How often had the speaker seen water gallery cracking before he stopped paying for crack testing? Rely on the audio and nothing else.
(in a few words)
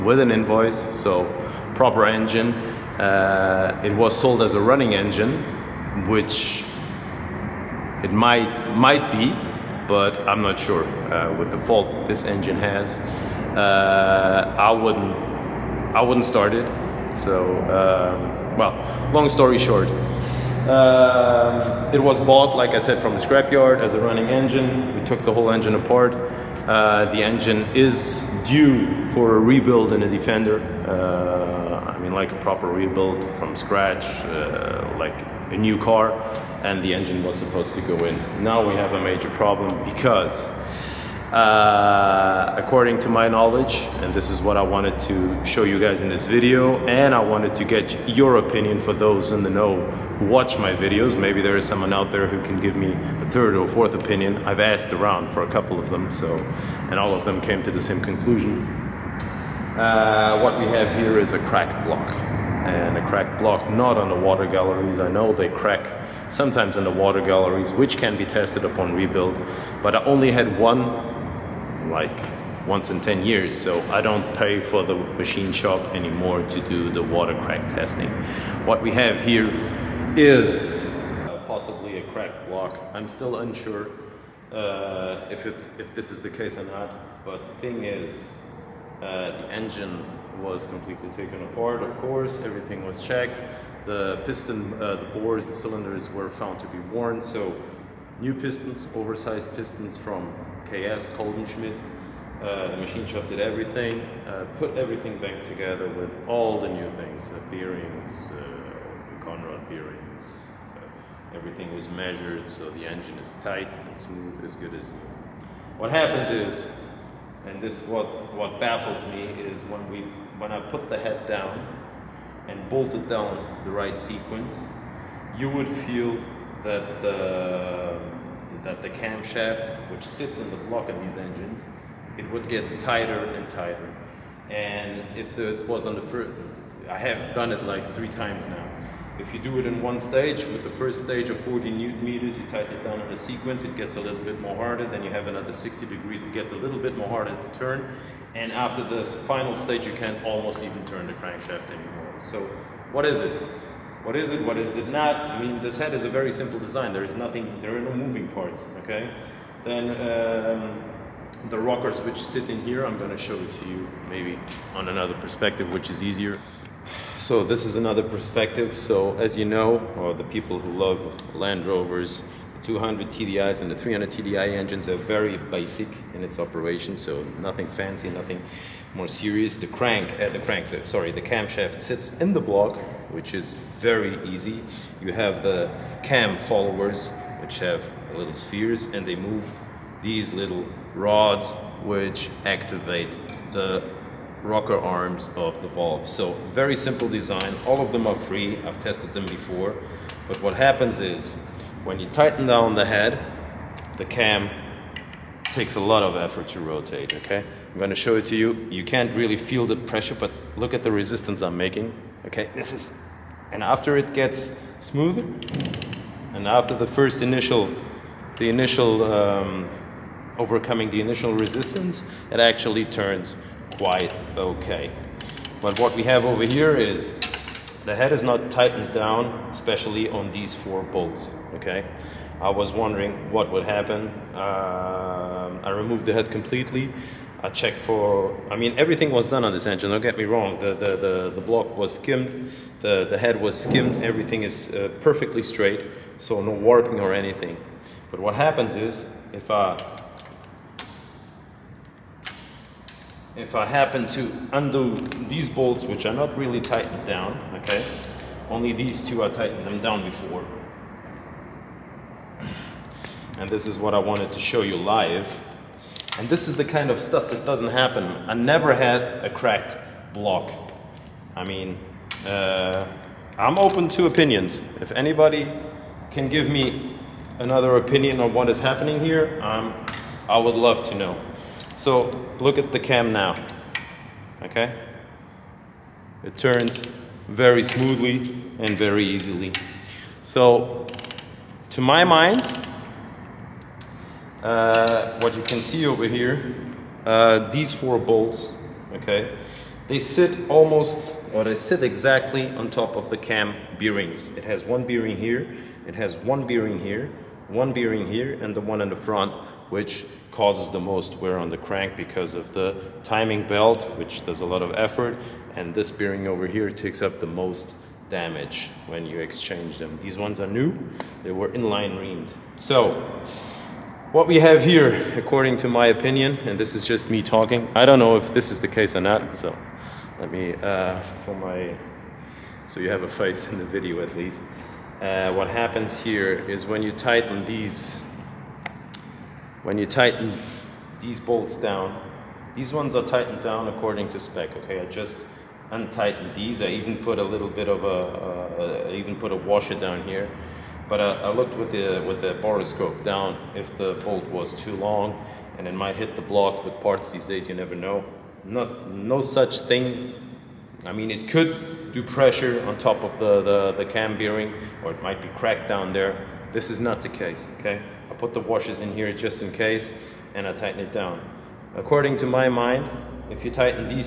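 once in 10 years.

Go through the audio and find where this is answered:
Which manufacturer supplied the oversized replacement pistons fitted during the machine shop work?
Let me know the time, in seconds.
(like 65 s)
100 s.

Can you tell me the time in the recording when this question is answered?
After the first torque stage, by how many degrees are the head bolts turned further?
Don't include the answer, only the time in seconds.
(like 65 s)
145 s.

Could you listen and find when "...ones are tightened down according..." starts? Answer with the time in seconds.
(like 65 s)
342 s.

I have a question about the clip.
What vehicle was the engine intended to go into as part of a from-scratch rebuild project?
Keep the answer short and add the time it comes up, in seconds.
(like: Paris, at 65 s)
Defender, at 30 s.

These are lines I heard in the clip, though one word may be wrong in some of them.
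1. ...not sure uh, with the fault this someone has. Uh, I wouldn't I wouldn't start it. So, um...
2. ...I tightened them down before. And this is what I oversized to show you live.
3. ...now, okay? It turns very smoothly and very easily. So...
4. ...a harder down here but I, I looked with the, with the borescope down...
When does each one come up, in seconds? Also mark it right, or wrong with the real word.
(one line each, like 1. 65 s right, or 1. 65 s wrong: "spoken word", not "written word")
1. 10 s wrong: "engine", not "someone"
2. 259 s wrong: "wanted", not "oversized"
3. 283 s right
4. 349 s wrong: "washer", not "harder".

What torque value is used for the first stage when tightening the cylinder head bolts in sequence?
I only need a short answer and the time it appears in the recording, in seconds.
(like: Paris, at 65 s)
40 newton meters, at 141 s.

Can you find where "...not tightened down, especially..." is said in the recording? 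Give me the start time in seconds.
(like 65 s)
228 s.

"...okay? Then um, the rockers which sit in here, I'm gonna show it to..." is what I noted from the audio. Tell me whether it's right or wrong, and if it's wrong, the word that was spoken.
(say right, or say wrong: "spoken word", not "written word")
right.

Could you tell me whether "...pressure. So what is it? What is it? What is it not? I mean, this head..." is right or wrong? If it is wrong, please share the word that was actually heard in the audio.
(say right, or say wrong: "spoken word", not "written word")
wrong: "anymore", not "pressure".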